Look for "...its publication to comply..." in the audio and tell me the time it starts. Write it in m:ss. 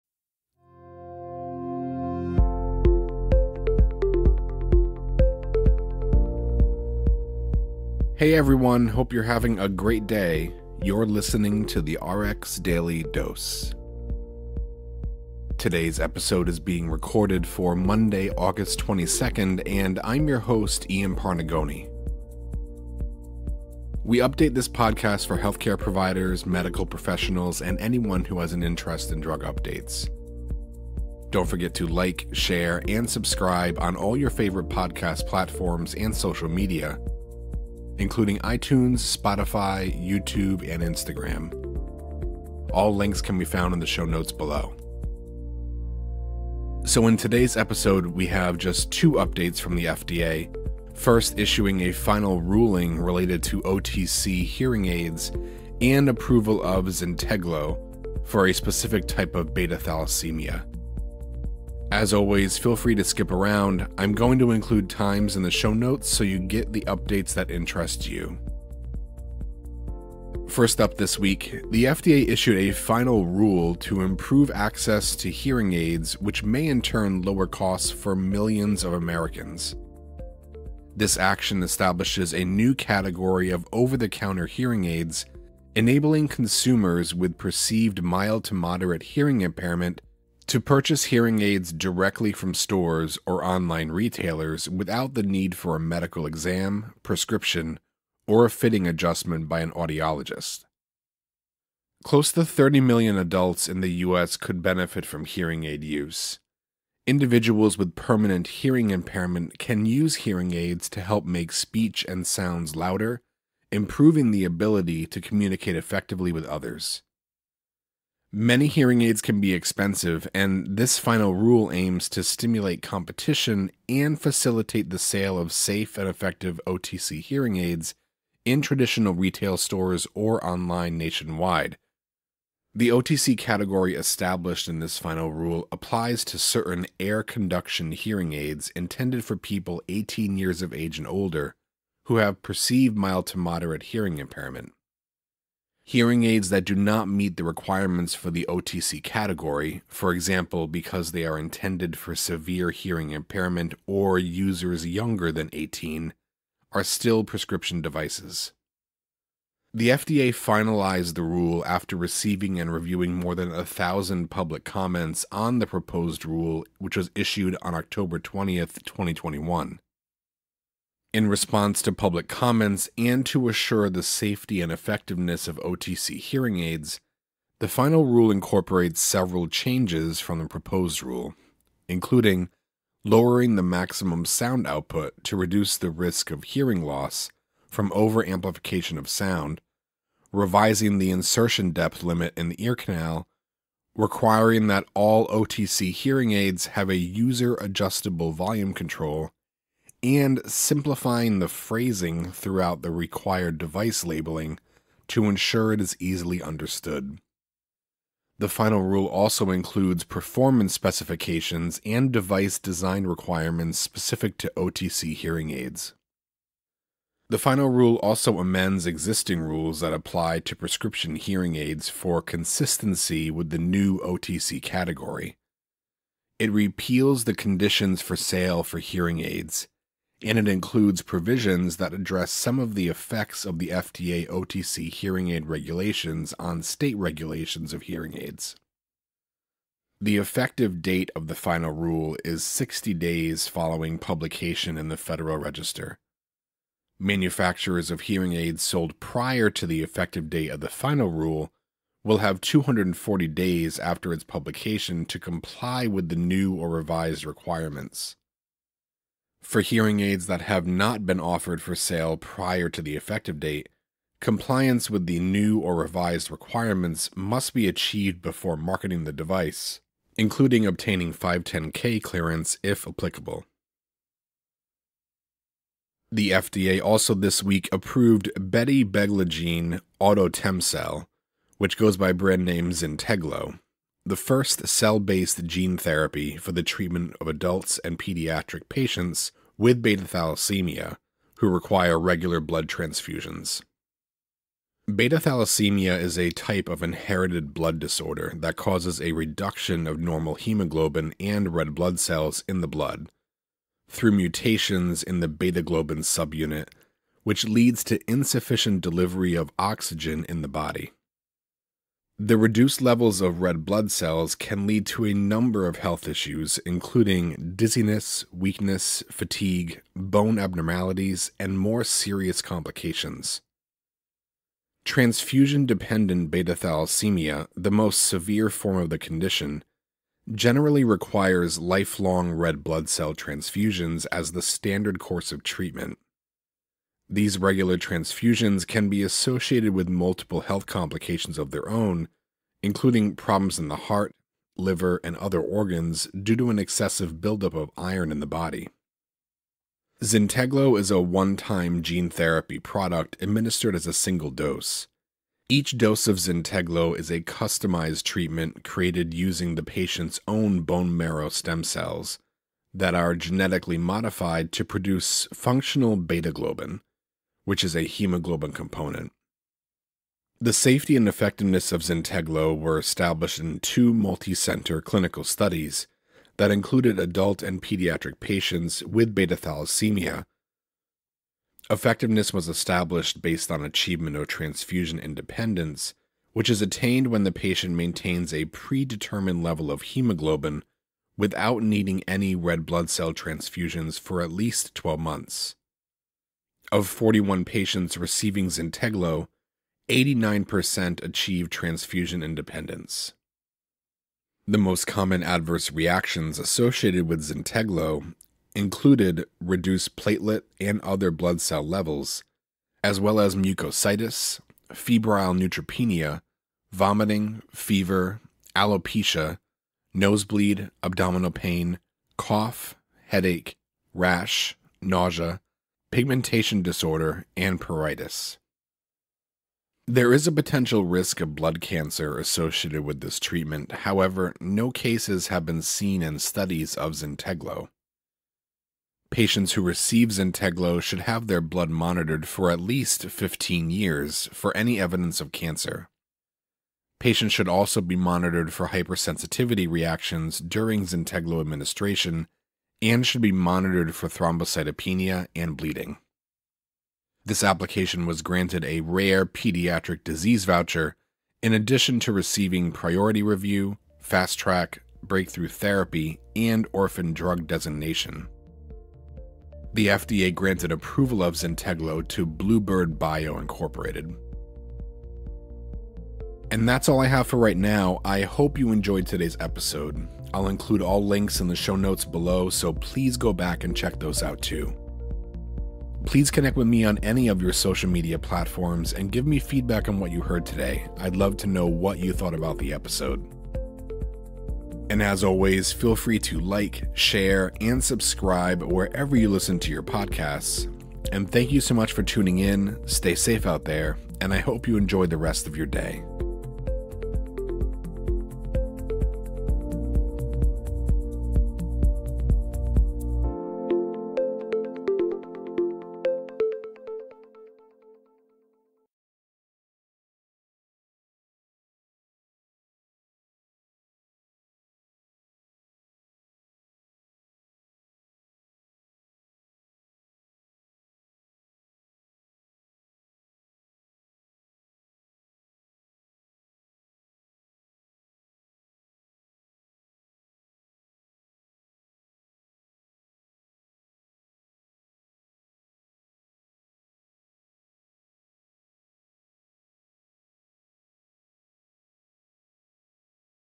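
4:14.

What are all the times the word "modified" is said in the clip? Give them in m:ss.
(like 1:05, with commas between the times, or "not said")
6:03.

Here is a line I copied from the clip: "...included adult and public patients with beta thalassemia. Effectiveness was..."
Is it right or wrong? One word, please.
wrong.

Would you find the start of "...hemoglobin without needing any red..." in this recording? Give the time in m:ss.
6:29.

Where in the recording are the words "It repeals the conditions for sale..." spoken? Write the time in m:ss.
3:46.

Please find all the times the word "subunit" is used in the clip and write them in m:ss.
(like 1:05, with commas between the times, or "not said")
5:05.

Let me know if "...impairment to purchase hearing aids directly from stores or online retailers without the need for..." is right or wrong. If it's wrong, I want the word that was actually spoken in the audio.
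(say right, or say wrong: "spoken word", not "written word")
right.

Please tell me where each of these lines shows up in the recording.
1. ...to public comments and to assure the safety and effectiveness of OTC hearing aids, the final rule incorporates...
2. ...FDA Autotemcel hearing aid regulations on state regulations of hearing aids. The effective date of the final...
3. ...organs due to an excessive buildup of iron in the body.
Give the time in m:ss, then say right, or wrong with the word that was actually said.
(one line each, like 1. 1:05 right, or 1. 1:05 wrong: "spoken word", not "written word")
1. 2:51 right
2. 3:53 wrong: "OTC", not "Autotemcel"
3. 5:45 right.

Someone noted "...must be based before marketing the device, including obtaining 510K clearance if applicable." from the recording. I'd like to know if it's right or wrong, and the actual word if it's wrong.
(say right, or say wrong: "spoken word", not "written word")
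wrong: "achieved", not "based".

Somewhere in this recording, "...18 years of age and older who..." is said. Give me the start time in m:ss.
2:19.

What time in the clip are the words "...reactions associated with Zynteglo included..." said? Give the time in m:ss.
6:45.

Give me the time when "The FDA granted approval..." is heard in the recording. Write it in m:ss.
7:49.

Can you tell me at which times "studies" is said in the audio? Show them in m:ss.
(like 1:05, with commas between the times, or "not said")
6:15, 7:16.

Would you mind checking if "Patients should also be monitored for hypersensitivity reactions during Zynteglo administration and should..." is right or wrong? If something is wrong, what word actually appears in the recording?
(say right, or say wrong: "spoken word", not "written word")
right.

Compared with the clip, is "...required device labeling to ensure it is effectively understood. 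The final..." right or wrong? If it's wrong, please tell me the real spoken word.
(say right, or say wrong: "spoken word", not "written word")
wrong: "easily", not "effectively".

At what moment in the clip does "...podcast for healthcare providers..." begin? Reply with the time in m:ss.
0:24.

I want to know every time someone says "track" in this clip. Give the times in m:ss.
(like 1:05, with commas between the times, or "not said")
7:44.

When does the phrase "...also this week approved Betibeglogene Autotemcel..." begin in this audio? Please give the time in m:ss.
4:36.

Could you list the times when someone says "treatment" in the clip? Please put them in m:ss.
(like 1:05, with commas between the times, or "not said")
4:46, 5:35, 5:58, 7:13.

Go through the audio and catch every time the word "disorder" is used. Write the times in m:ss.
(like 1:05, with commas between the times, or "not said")
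4:57, 7:06.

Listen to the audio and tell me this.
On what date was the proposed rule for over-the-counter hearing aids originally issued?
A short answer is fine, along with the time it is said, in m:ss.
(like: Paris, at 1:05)
October 20th, 2021, at 2:47.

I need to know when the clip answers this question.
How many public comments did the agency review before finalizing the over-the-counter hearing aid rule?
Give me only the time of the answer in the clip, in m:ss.
2:43.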